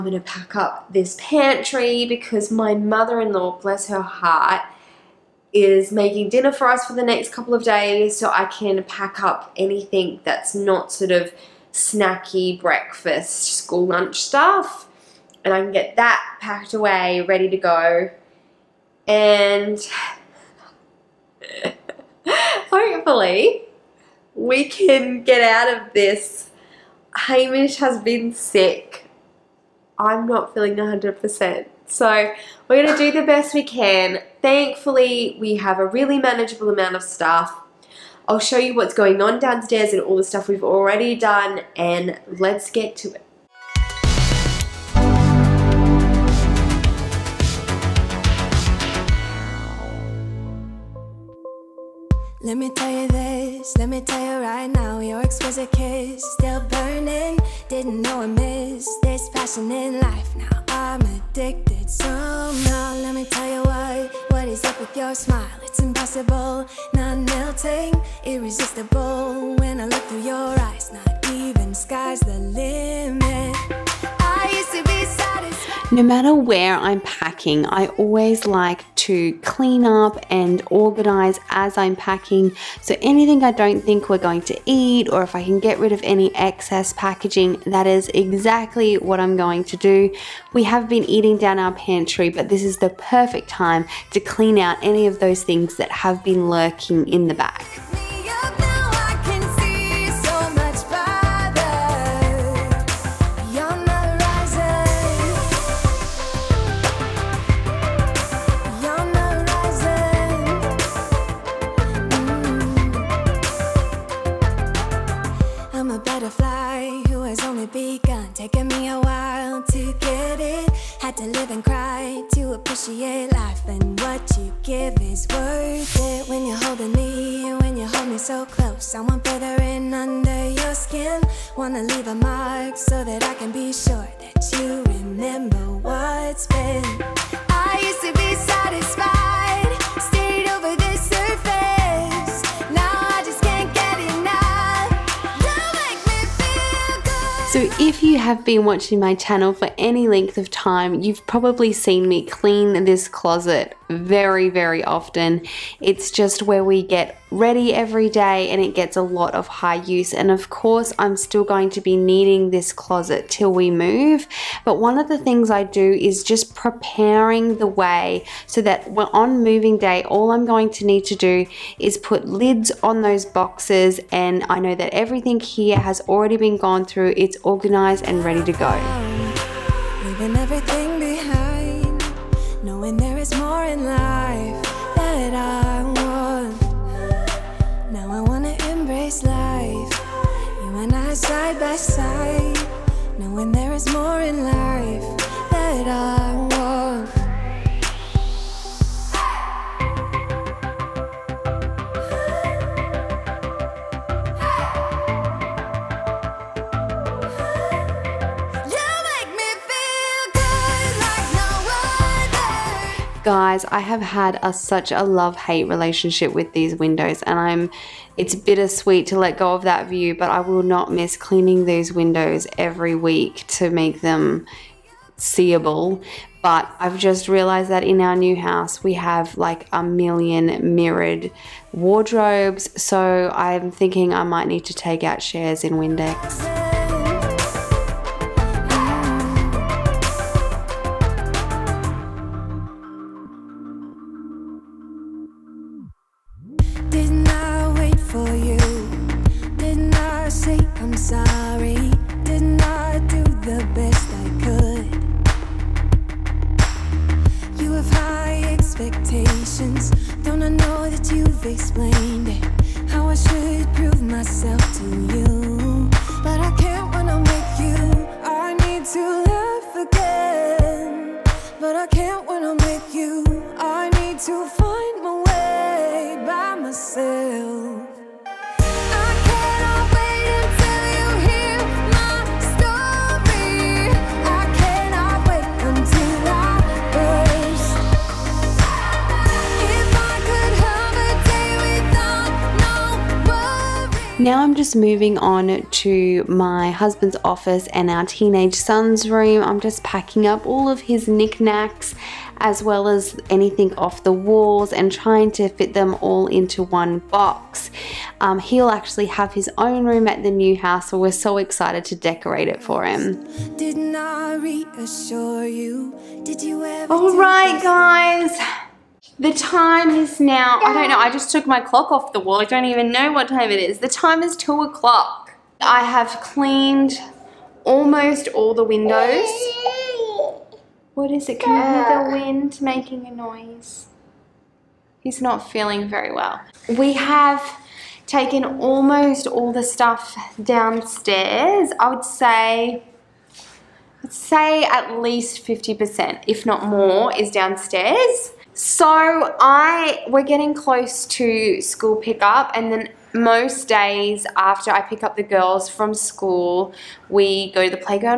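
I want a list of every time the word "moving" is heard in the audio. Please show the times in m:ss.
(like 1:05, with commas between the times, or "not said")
2:49, 4:54.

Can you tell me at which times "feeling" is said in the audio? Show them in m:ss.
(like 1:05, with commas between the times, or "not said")
0:30, 5:35.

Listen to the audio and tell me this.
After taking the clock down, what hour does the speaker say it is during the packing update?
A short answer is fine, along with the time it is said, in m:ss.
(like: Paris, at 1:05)
2 o'clock, at 5:24.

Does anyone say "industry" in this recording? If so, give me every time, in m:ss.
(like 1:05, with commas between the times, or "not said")
not said.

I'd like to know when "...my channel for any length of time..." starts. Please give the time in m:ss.
2:28.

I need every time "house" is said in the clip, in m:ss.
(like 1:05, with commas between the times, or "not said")
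3:48, 5:10.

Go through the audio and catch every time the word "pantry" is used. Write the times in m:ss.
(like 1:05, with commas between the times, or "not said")
0:01, 1:31.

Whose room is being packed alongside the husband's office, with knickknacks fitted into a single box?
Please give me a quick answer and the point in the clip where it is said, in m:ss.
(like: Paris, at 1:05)
Teenage son's, at 4:57.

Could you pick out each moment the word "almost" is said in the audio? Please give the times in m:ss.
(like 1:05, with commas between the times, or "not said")
5:27, 5:38.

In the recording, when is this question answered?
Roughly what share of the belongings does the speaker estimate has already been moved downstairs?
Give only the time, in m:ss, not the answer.
5:45.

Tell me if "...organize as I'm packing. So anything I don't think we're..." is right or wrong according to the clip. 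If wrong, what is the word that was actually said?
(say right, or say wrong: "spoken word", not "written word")
right.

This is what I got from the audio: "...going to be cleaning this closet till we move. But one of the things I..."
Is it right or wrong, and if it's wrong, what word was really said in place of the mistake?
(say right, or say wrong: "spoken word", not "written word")
wrong: "needing", not "cleaning".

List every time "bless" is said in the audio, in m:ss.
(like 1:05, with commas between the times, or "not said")
0:03.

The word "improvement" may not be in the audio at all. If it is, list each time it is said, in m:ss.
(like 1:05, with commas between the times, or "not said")
not said.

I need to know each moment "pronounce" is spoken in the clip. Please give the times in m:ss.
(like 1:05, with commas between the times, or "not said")
not said.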